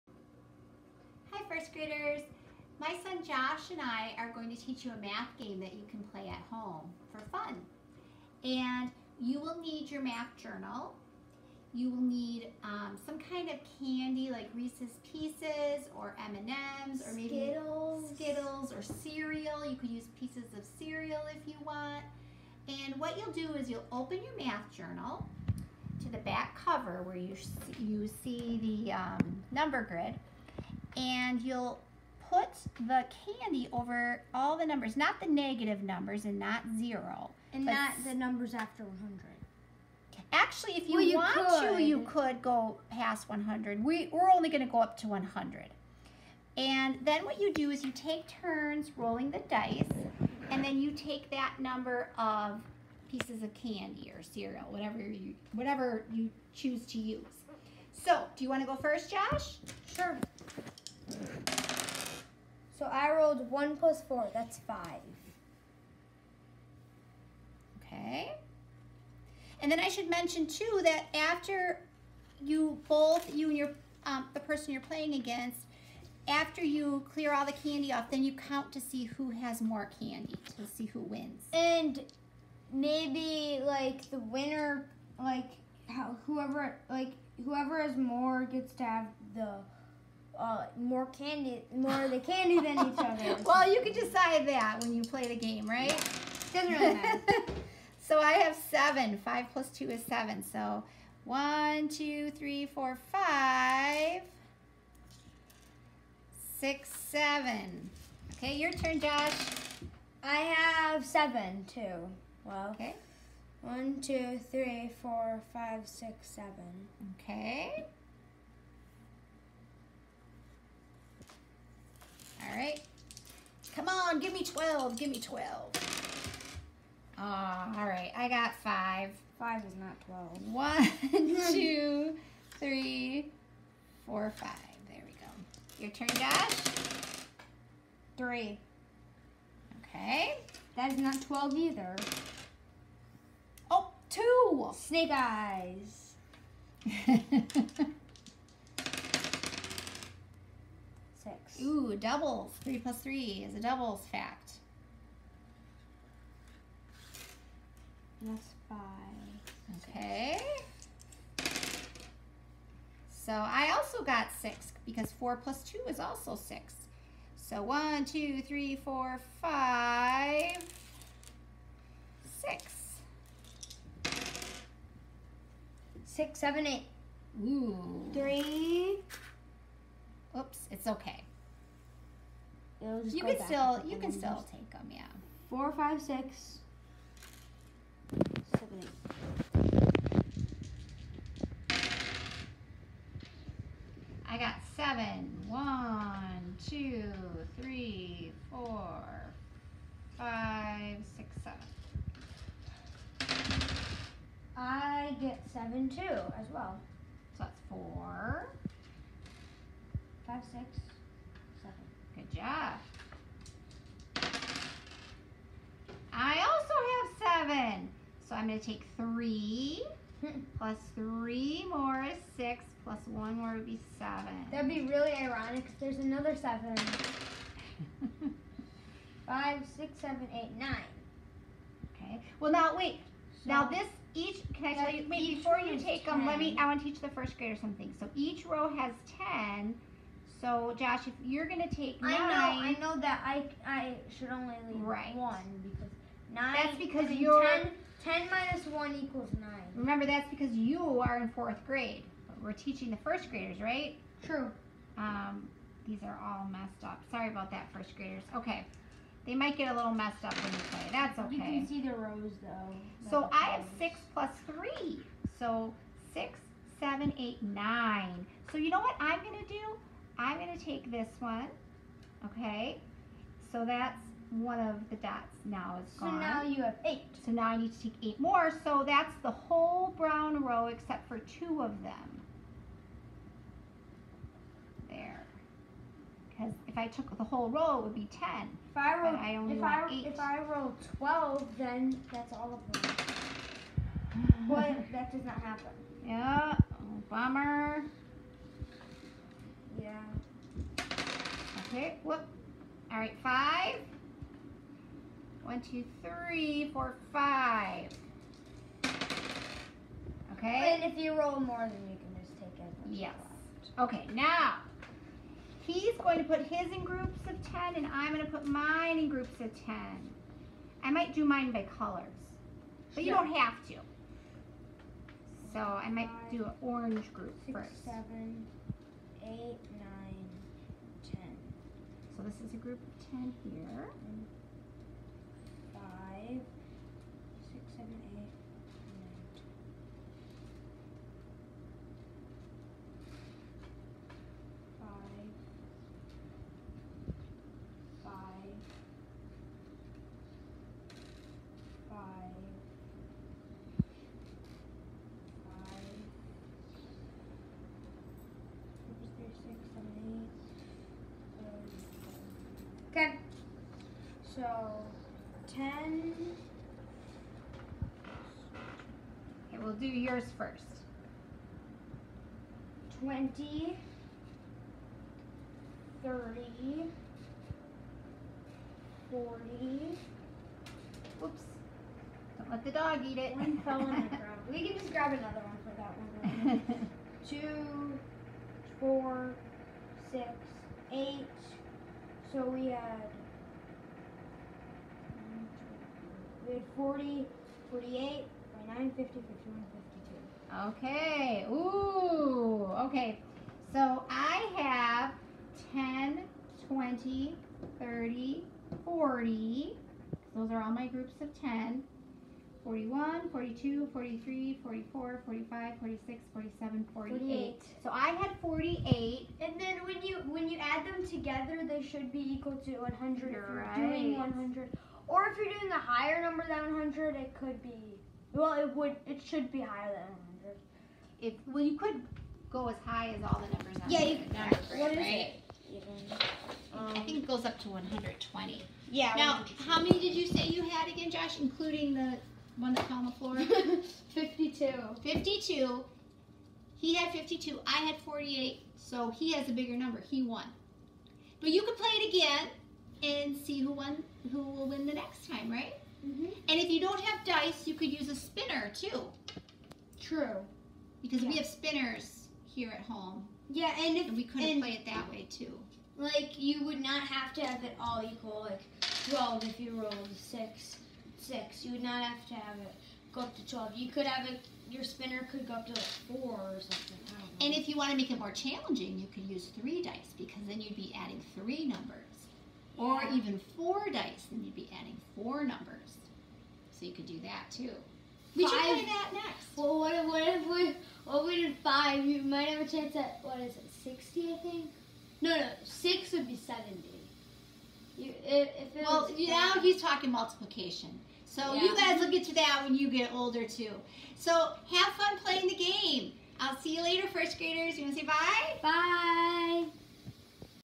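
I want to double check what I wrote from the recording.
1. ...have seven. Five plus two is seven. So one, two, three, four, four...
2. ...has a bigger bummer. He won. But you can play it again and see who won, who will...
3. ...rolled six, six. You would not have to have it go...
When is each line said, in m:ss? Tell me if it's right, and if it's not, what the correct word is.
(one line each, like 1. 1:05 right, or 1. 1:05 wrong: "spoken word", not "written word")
1. 1:38 wrong: "five", not "four"
2. 7:29 wrong: "number", not "bummer"
3. 7:49 right.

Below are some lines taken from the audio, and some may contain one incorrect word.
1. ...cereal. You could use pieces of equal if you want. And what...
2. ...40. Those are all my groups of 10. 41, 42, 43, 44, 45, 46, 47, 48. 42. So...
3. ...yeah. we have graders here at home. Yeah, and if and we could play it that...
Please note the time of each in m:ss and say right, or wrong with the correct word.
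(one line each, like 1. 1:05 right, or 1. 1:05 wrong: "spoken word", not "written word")
1. 0:18 wrong: "cereal", not "equal"
2. 6:48 wrong: "48", not "42"
3. 7:41 wrong: "spinners", not "graders".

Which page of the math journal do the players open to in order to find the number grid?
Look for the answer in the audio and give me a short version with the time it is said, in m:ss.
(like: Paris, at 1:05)
Back cover, at 0:26.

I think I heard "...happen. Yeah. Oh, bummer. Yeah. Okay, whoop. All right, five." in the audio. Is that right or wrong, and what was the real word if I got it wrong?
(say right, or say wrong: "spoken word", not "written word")
right.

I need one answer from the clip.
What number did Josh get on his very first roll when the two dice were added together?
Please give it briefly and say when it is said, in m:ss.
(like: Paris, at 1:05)
5, at 1:03.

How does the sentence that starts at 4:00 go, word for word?
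So Josh, if you're gonna take nine, I know, I know that I I should only leave right.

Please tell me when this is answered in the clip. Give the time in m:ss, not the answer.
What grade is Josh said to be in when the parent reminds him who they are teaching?
4:11.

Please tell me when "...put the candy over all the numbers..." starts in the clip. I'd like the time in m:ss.
0:32.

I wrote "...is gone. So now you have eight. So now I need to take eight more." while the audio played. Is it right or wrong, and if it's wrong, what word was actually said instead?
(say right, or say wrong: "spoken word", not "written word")
right.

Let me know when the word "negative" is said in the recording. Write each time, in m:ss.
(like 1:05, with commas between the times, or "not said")
0:35.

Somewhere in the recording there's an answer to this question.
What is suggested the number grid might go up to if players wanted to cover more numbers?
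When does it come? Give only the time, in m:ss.
7:17.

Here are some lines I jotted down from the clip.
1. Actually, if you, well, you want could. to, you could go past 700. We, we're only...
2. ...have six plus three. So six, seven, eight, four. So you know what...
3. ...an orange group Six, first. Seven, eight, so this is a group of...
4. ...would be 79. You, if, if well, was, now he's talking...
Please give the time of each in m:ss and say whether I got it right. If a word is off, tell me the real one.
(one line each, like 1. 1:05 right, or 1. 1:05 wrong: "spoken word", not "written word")
1. 0:40 wrong: "100", not "700"
2. 4:23 wrong: "nine", not "four"
3. 5:26 right
4. 8:16 wrong: "70", not "79".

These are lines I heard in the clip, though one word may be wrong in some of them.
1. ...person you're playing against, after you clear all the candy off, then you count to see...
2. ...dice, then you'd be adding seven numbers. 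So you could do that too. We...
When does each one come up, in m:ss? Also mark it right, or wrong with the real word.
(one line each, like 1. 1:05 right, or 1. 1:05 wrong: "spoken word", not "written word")
1. 1:14 right
2. 8:03 wrong: "four", not "seven".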